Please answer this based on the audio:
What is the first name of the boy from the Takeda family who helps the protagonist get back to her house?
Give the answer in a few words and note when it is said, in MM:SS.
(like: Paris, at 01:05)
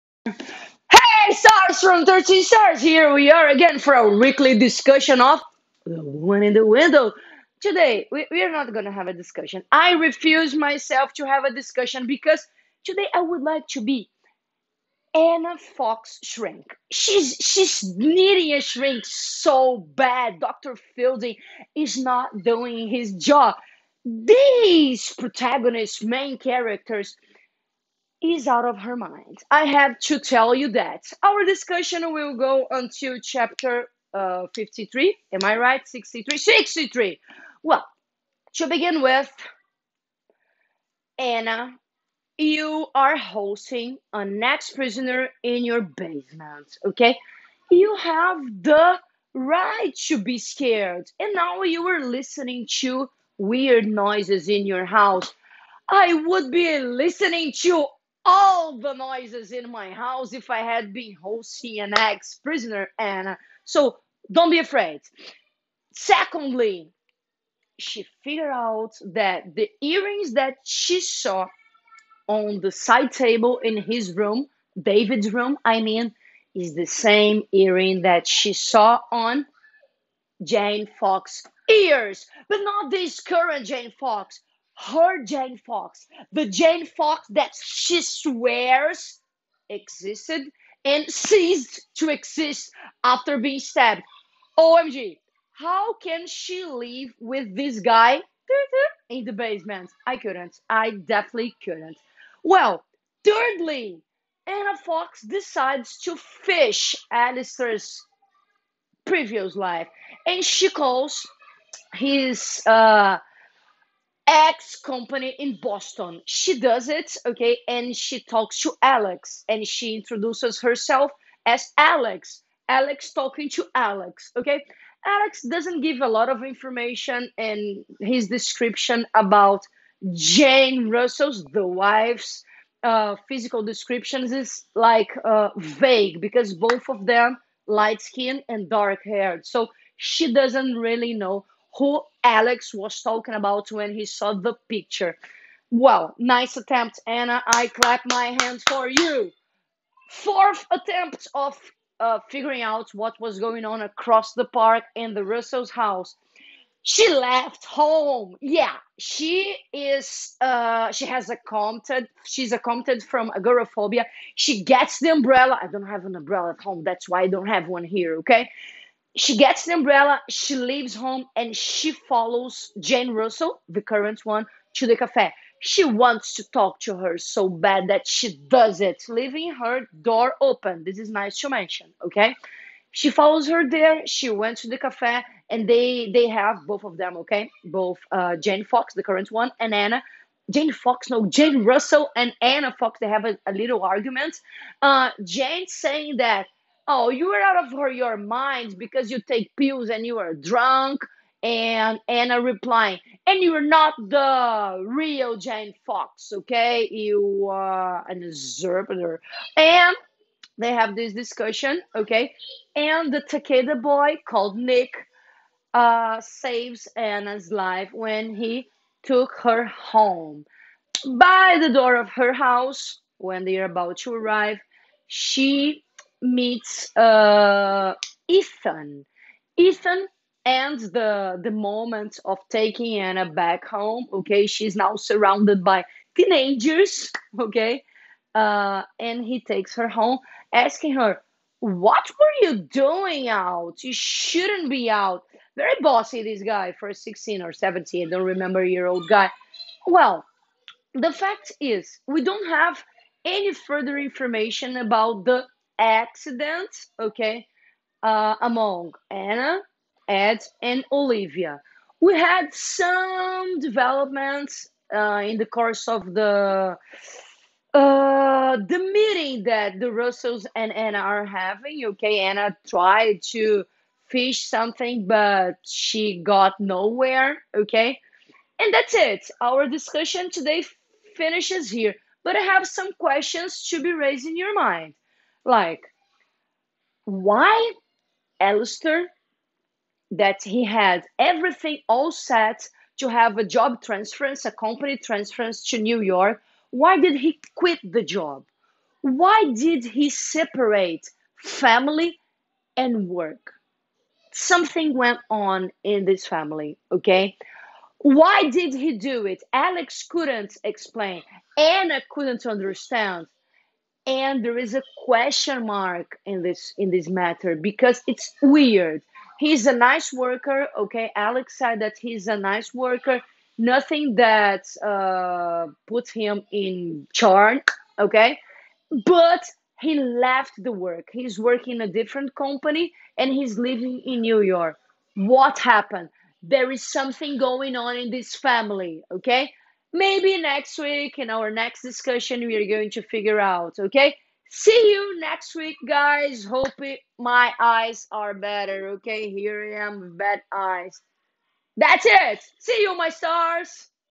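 Nick, at 03:34.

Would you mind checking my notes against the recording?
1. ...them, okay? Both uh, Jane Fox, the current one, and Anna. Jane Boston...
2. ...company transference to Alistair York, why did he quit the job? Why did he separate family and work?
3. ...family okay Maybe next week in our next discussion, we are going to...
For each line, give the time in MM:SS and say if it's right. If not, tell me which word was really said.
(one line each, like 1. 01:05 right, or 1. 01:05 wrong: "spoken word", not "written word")
1. 03:06 wrong: "Fox", not "Boston"
2. 04:54 wrong: "New", not "Alistair"
3. 05:38 right.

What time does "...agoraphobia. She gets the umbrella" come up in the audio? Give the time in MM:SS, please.
02:43.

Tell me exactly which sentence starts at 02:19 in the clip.
So she doesn't really know who Alex was talking about when he saw the picture.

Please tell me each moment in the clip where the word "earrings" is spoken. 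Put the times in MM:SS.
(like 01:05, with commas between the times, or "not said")
01:09, 01:17.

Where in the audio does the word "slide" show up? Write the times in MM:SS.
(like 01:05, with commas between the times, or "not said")
not said.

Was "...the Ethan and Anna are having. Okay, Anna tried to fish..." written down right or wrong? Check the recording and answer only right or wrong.
wrong.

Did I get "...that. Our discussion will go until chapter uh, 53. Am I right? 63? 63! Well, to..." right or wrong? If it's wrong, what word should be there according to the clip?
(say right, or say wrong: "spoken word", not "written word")
right.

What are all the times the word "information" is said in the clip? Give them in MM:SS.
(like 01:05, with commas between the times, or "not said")
02:06, 04:13.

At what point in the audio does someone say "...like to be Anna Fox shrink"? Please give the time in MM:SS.
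00:13.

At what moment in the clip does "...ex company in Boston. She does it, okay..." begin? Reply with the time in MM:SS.
01:54.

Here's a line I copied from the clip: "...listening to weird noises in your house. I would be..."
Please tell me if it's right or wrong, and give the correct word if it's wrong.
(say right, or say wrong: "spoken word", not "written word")
right.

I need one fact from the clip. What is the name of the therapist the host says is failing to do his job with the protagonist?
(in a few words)
Dr. Fielding.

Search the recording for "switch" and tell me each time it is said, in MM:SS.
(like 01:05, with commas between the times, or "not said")
not said.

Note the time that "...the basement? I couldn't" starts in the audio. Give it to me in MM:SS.
01:39.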